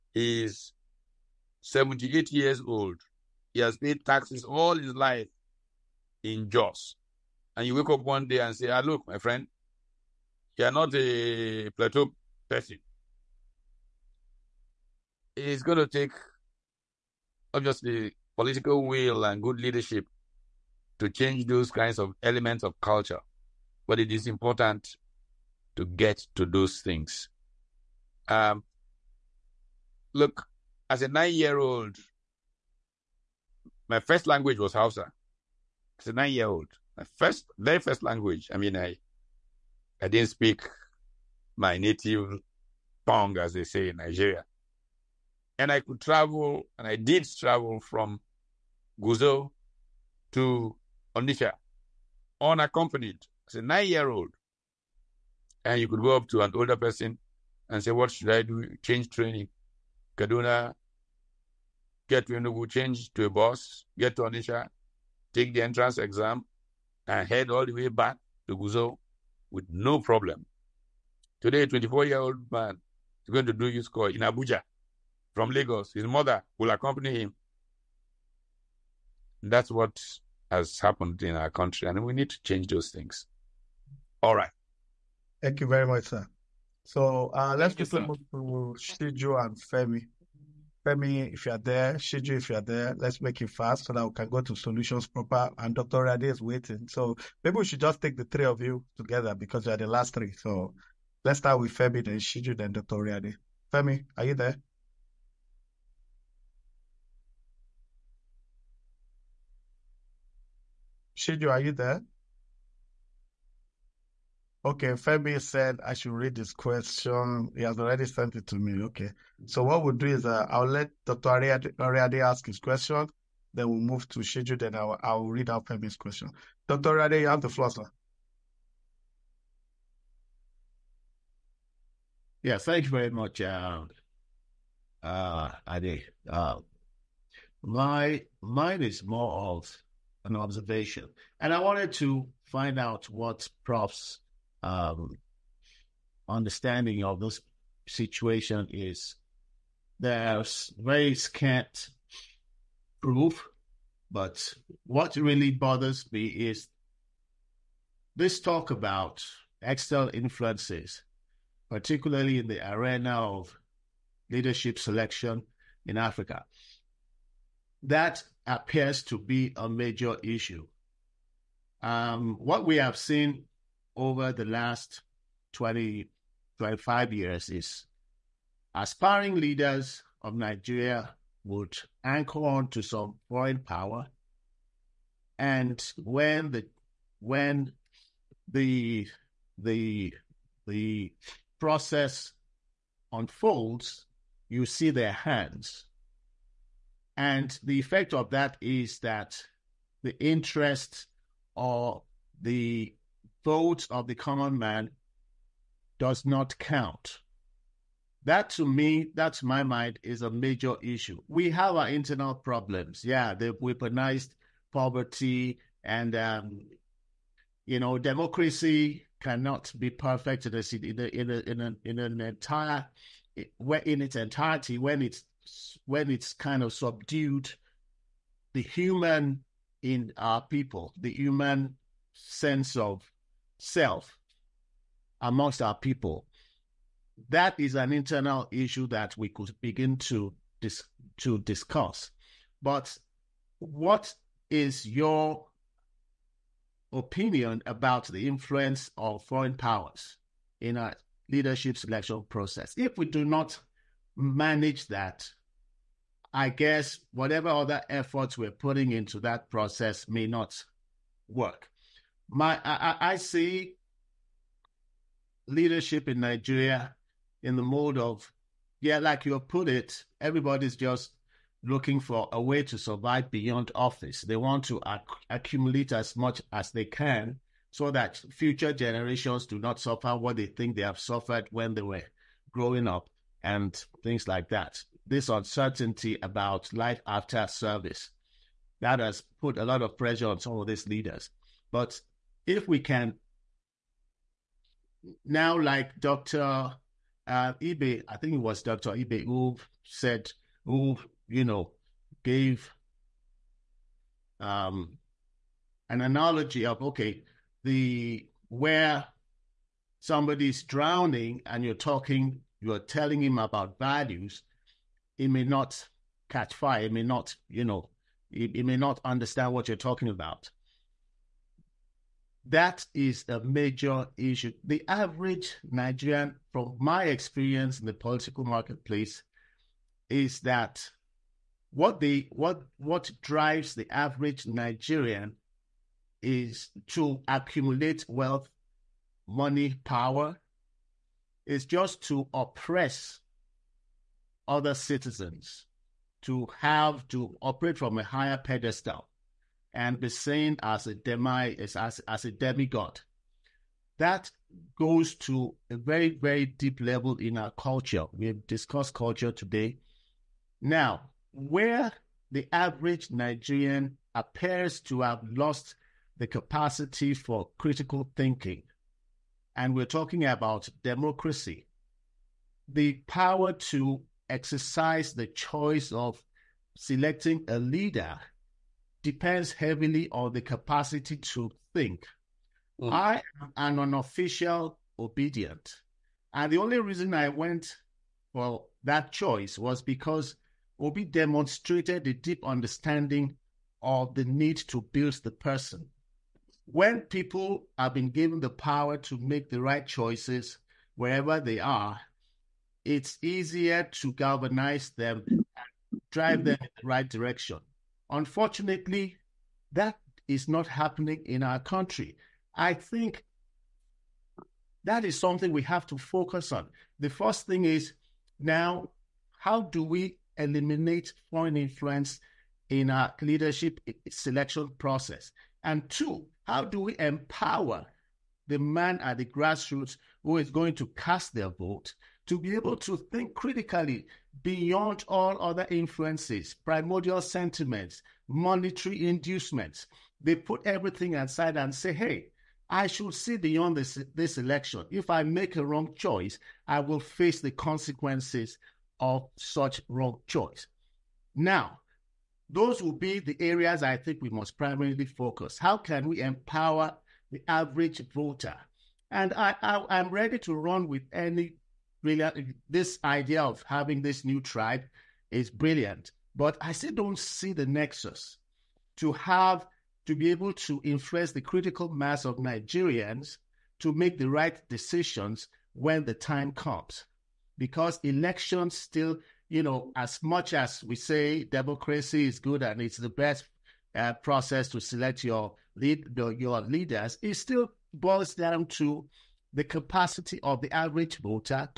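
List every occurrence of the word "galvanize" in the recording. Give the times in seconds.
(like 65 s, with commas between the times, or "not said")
404 s.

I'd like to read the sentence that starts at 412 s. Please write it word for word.
I think that is something we have to focus on.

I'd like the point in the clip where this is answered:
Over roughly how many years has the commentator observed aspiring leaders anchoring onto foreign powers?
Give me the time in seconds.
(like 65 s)
175 s.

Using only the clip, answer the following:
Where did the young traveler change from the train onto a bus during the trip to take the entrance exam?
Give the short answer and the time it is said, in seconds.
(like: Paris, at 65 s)
Kaduna, at 60 s.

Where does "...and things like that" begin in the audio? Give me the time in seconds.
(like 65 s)
283 s.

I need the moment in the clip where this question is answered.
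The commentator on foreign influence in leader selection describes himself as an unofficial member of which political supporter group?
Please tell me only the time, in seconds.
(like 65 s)
384 s.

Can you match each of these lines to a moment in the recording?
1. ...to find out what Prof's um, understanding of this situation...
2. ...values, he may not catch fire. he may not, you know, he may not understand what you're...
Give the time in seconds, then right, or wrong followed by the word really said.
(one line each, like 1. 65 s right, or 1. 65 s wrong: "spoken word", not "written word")
1. 141 s right
2. 313 s right.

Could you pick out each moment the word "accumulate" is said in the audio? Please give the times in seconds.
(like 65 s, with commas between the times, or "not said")
275 s, 337 s.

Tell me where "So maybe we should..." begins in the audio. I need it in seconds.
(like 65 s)
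96 s.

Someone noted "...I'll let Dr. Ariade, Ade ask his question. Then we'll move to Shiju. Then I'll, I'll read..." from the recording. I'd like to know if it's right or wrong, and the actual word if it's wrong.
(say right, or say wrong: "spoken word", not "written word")
wrong: "Ariade", not "Ade".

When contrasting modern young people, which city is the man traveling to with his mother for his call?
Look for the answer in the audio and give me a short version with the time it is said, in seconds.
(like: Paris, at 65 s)
Abuja, at 74 s.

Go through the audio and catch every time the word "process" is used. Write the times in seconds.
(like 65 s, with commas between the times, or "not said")
191 s, 252 s, 259 s, 424 s, 484 s.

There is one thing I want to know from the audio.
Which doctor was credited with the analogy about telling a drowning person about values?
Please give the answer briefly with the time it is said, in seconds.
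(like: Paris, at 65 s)
Dr. Ibe, at 298 s.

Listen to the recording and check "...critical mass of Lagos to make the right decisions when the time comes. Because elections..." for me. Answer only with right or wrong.
wrong.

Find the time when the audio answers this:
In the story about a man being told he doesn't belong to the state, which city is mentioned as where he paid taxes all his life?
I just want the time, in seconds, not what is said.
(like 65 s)
6 s.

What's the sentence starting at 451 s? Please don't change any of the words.
Now, those will be the areas I think we must primarily focus.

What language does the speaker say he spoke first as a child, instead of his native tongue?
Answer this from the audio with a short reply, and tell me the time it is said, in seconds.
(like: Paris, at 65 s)
Hausa, at 34 s.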